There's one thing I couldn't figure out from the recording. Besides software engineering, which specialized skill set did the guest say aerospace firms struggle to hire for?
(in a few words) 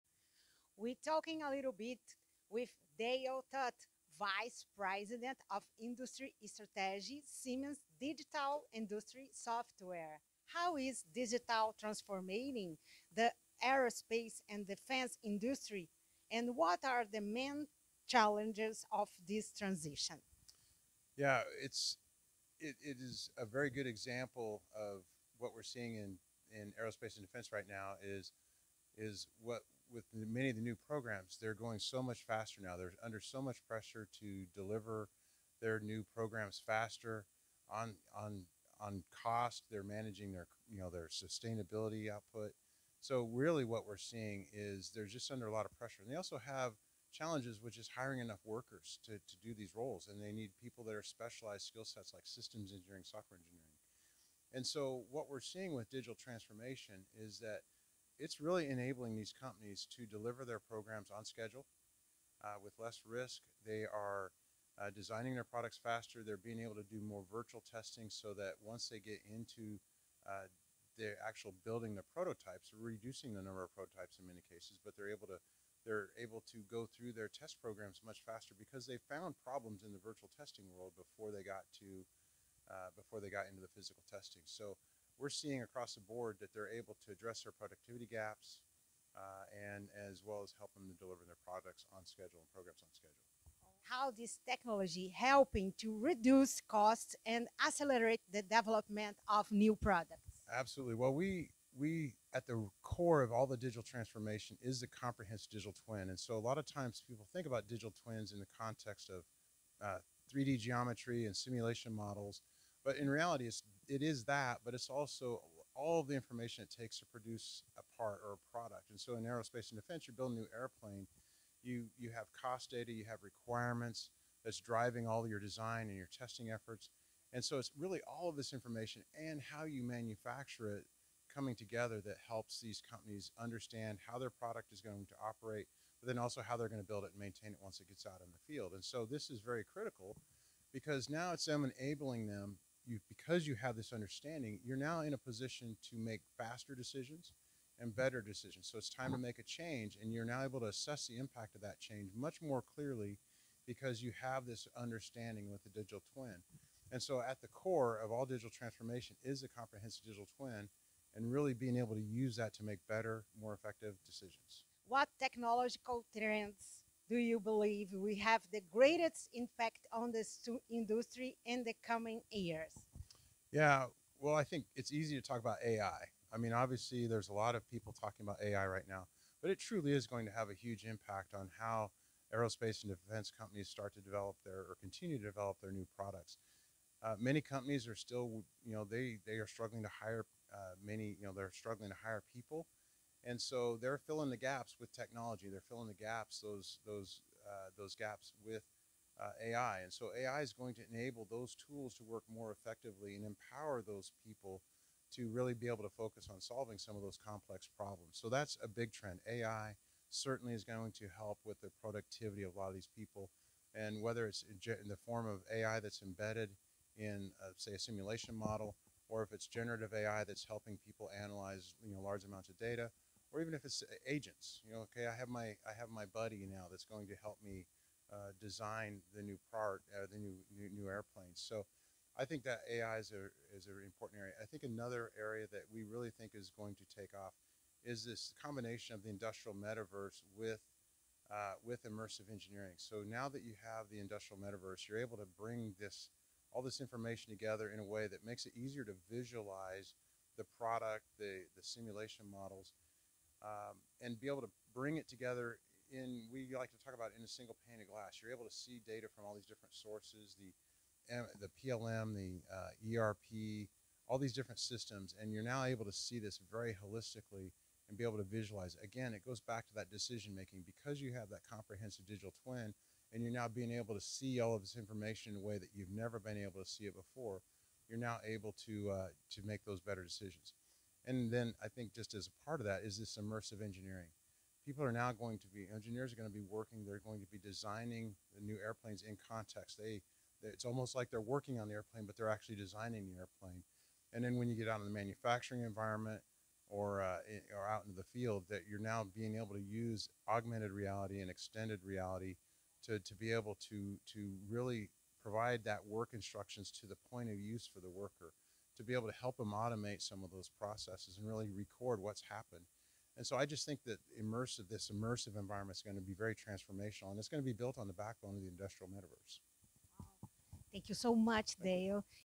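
Systems engineering.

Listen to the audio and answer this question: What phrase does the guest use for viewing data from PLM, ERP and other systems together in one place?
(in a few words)
Single pane of glass.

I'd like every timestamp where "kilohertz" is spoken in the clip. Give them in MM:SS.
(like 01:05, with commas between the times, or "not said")
not said.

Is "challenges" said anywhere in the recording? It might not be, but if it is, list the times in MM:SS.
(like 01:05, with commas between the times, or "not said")
00:18, 00:47.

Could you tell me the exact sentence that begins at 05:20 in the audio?
Thank you so much, Thank Dale.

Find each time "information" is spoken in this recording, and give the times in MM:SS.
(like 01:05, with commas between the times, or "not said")
01:56, 02:08, 04:06, 04:34.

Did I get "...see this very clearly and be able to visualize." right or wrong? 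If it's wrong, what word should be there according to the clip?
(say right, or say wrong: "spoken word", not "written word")
wrong: "holistically", not "clearly".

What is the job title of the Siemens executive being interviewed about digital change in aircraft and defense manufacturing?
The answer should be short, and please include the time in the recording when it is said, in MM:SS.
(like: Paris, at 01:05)
Vice President of Industry Strategy, at 00:04.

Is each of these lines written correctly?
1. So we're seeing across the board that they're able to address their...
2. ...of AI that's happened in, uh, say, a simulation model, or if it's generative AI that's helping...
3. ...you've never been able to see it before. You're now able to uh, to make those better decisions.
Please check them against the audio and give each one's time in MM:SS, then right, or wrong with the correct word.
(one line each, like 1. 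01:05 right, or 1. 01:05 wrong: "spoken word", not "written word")
1. 01:24 right
2. 03:35 wrong: "embedded", not "happened"
3. 04:35 right.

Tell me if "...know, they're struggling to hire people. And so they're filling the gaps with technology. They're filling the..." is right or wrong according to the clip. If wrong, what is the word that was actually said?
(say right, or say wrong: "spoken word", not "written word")
right.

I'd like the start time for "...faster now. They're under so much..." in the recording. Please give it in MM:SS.
00:32.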